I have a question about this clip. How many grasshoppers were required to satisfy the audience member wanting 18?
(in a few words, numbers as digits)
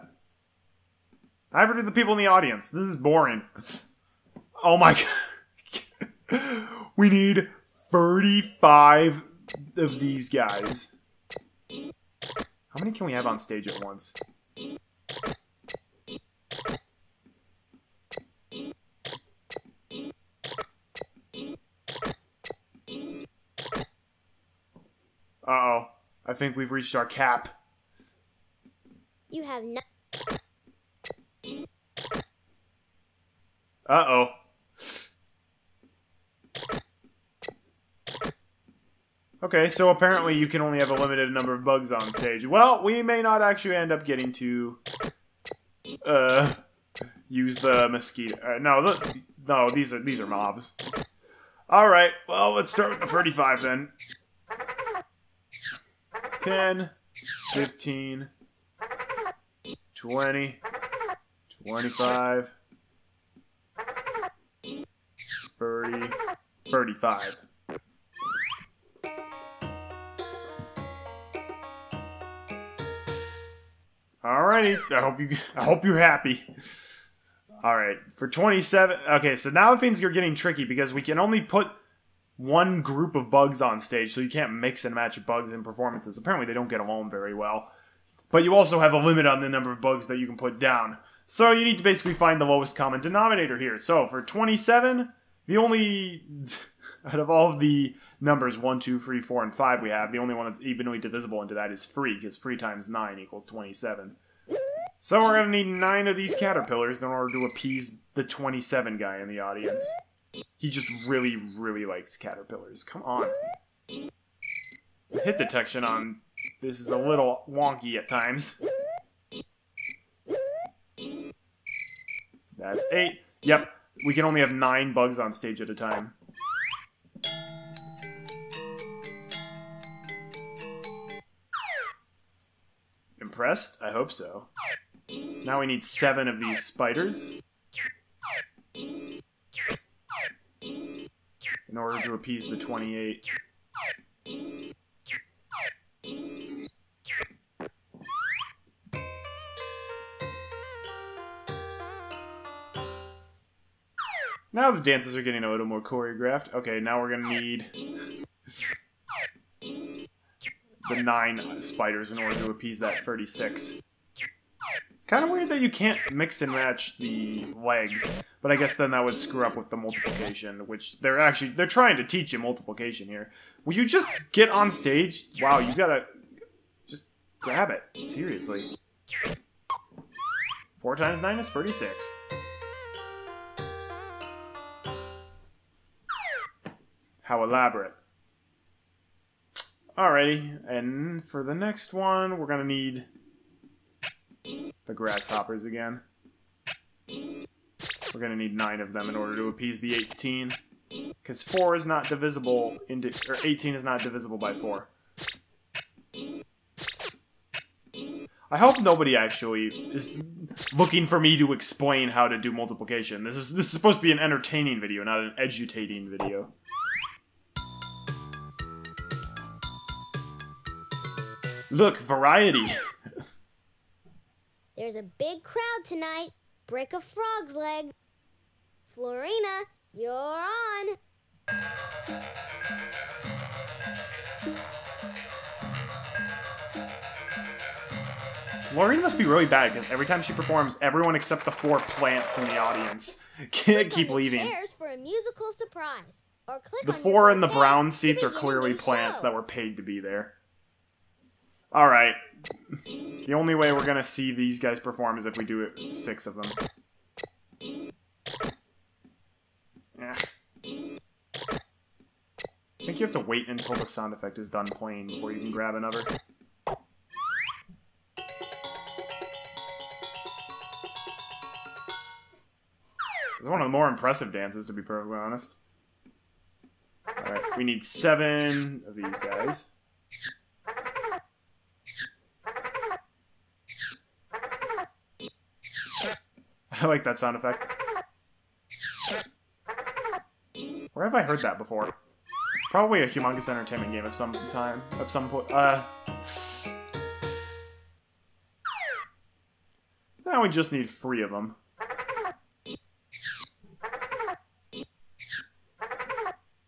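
9.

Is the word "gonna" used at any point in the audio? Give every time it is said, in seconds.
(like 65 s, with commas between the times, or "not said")
157 s, 192 s, 198 s, 253 s.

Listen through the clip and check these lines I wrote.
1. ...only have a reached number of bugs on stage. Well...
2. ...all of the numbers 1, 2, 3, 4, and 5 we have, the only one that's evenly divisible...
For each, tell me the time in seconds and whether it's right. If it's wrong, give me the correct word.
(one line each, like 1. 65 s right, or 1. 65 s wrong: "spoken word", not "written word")
1. 40 s wrong: "limited", not "reached"
2. 97 s right.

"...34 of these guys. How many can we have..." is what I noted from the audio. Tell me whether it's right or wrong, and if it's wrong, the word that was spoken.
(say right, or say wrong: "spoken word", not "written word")
wrong: "35", not "34".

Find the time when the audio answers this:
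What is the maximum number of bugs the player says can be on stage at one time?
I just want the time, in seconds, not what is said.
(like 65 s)
124 s.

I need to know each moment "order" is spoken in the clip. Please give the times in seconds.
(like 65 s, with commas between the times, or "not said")
107 s, 141 s, 162 s, 199 s.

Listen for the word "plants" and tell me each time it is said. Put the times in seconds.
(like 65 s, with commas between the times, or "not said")
241 s, 248 s.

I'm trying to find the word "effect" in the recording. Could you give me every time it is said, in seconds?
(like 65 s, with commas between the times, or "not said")
264 s, 287 s.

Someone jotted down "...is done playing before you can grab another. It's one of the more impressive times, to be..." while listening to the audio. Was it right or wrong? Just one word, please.
wrong.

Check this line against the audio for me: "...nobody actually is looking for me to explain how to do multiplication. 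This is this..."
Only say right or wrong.
right.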